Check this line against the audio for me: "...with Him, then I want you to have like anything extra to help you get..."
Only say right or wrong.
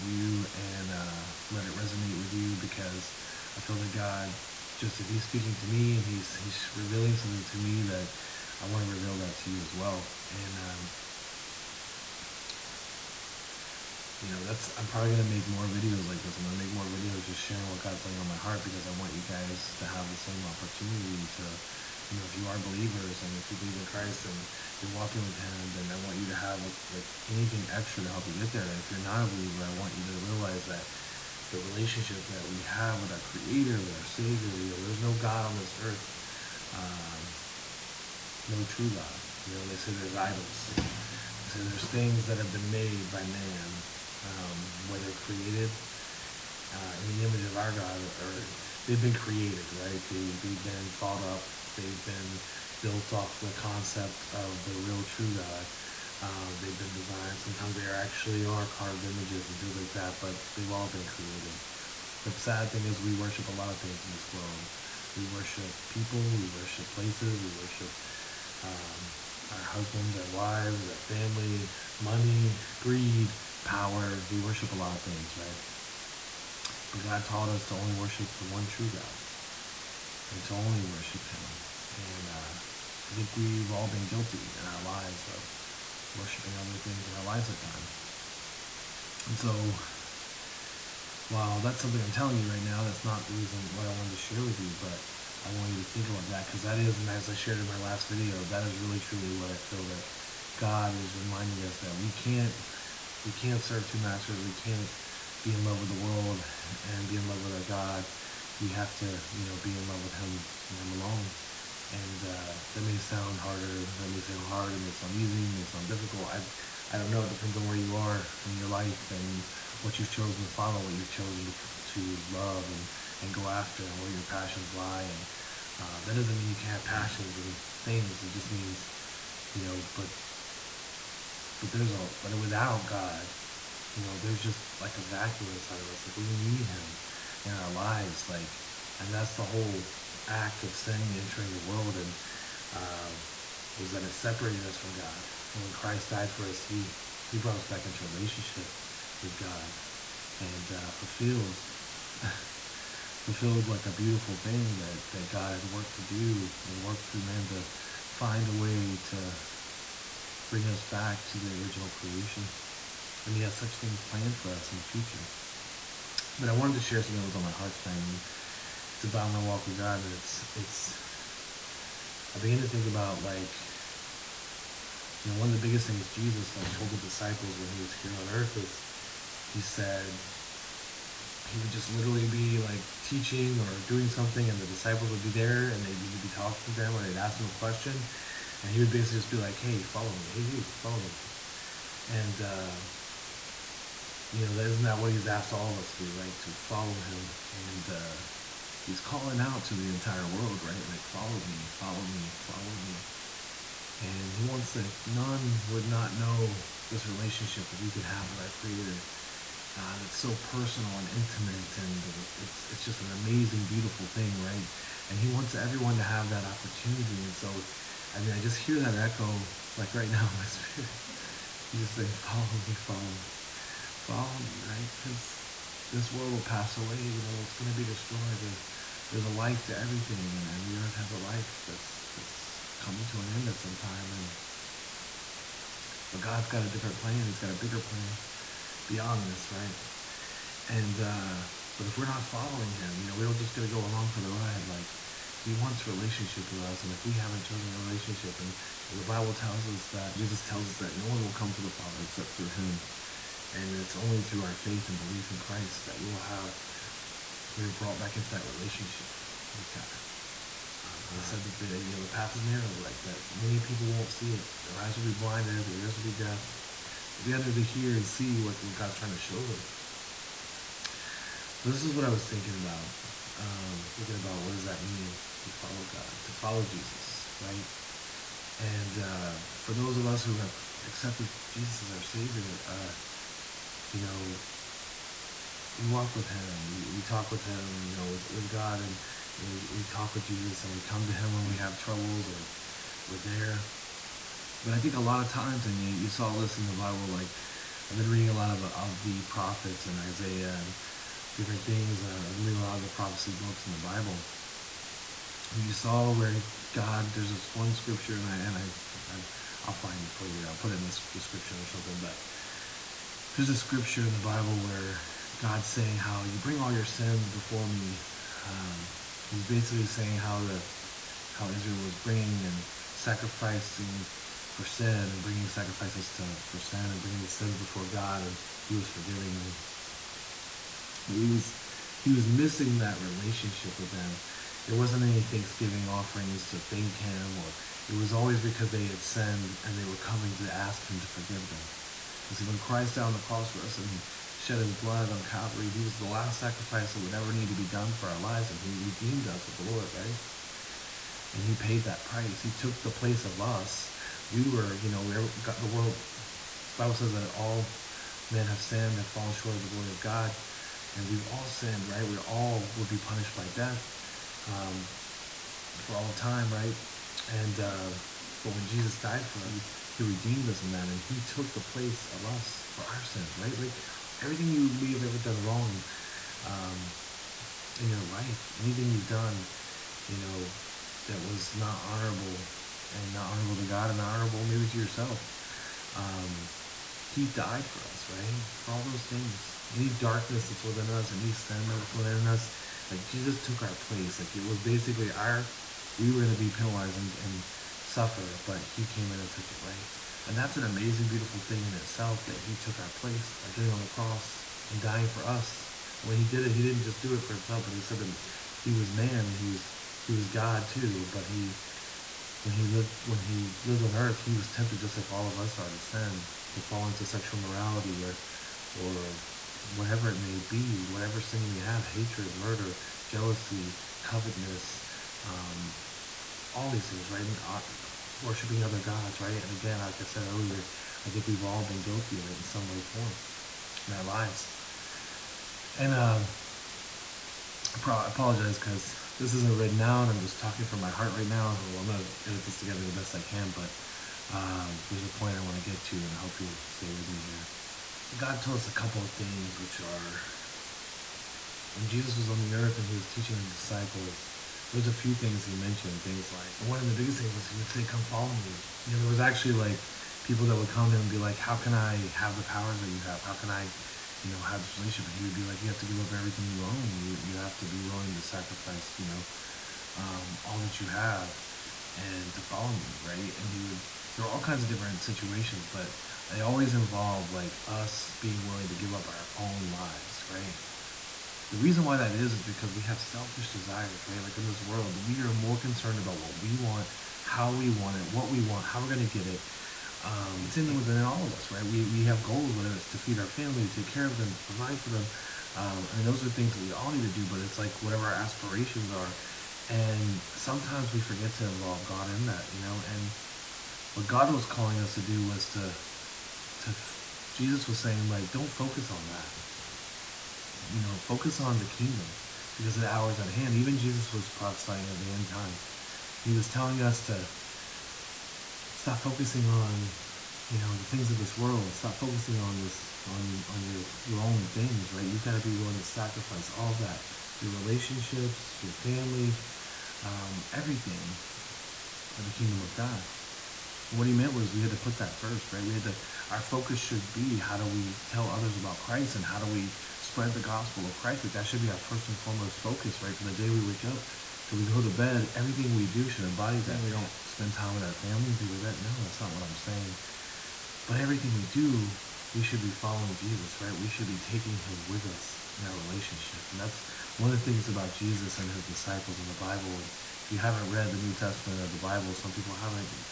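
right.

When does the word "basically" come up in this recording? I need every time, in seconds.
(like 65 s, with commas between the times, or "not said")
188 s, 319 s, 394 s.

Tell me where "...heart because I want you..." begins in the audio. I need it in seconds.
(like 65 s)
18 s.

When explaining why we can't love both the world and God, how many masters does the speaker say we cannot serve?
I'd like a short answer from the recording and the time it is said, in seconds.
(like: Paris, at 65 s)
2, at 103 s.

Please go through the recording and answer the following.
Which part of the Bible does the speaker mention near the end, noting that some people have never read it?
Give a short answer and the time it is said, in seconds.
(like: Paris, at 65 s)
New Testament, at 560 s.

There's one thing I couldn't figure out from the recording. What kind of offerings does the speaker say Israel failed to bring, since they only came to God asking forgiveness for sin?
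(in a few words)
Thanksgiving offerings.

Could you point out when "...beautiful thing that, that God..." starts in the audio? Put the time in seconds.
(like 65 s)
153 s.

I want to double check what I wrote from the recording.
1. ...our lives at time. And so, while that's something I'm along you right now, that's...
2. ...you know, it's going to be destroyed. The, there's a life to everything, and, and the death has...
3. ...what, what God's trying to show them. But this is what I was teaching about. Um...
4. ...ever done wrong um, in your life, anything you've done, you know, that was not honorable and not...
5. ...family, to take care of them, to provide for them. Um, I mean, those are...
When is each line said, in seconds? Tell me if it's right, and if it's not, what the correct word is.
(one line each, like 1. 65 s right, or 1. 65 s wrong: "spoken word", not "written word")
1. 87 s wrong: "telling", not "along"
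2. 226 s wrong: "earth", not "death"
3. 268 s wrong: "thinking", not "teaching"
4. 375 s right
5. 493 s right.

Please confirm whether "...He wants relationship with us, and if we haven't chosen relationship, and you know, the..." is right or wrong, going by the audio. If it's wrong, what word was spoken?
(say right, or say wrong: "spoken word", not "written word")
right.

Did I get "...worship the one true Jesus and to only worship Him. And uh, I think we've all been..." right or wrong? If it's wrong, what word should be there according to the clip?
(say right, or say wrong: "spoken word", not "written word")
wrong: "God", not "Jesus".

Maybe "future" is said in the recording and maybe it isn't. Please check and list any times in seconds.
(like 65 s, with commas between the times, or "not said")
164 s.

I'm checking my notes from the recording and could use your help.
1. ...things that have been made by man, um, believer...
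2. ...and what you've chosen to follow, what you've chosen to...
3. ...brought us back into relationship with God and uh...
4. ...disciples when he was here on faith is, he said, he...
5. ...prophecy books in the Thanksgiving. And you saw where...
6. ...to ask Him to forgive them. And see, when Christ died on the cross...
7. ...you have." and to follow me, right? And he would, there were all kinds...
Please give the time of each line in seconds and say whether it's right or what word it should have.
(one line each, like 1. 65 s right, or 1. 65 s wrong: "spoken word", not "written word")
1. 41 s wrong: "whether", not "believer"
2. 119 s right
3. 147 s right
4. 176 s wrong: "earth", not "faith"
5. 302 s wrong: "Bible", not "Thanksgiving"
6. 340 s right
7. 470 s right.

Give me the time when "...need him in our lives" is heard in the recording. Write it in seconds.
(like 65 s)
136 s.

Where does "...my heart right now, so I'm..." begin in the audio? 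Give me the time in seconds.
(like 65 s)
440 s.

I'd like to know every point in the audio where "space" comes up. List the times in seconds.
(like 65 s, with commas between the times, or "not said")
not said.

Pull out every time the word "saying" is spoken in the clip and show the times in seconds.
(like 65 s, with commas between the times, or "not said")
221 s, 315 s, 319 s, 507 s, 549 s.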